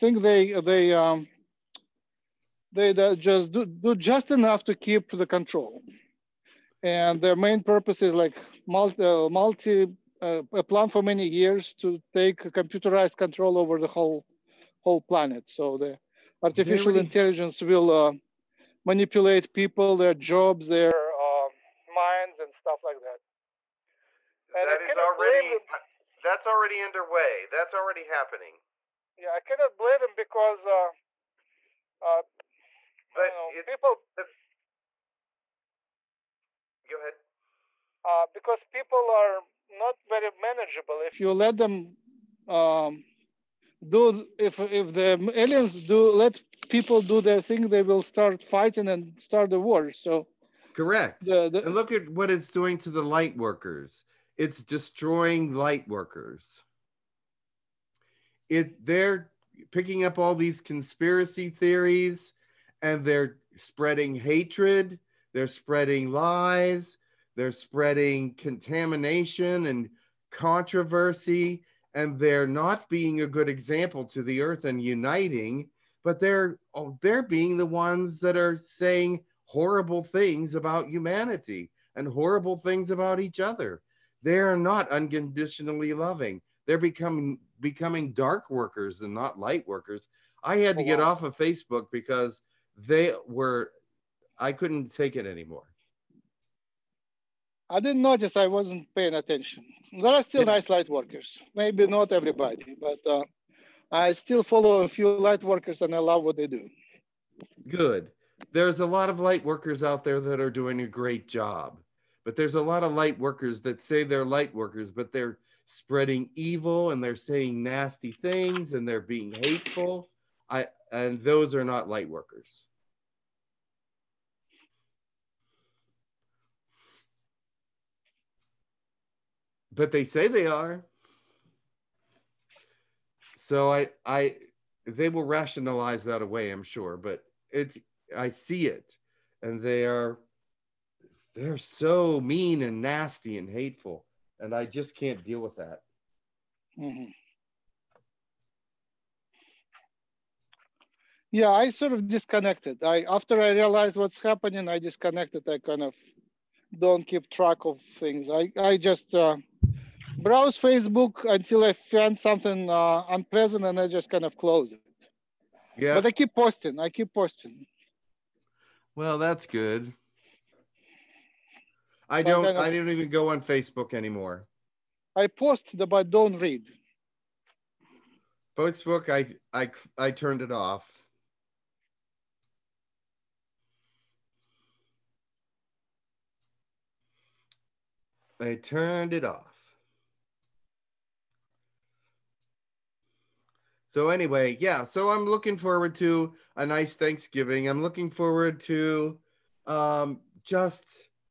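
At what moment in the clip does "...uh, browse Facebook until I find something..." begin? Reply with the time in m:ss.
2:39.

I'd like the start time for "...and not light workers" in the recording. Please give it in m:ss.
1:29.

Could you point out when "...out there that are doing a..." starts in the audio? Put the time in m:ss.
1:49.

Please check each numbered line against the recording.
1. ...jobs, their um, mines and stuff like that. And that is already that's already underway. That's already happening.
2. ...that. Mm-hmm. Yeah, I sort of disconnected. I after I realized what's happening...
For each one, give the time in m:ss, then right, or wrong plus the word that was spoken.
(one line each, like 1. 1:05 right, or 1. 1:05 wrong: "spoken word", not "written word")
1. 0:20 right
2. 2:25 right.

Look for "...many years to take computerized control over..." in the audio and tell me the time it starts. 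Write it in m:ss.
0:11.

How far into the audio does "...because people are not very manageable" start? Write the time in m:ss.
0:38.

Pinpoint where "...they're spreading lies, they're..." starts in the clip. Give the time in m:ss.
1:05.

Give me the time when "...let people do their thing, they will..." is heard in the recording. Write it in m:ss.
0:46.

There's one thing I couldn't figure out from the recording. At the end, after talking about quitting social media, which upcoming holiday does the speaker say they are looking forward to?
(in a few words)
Thanksgiving.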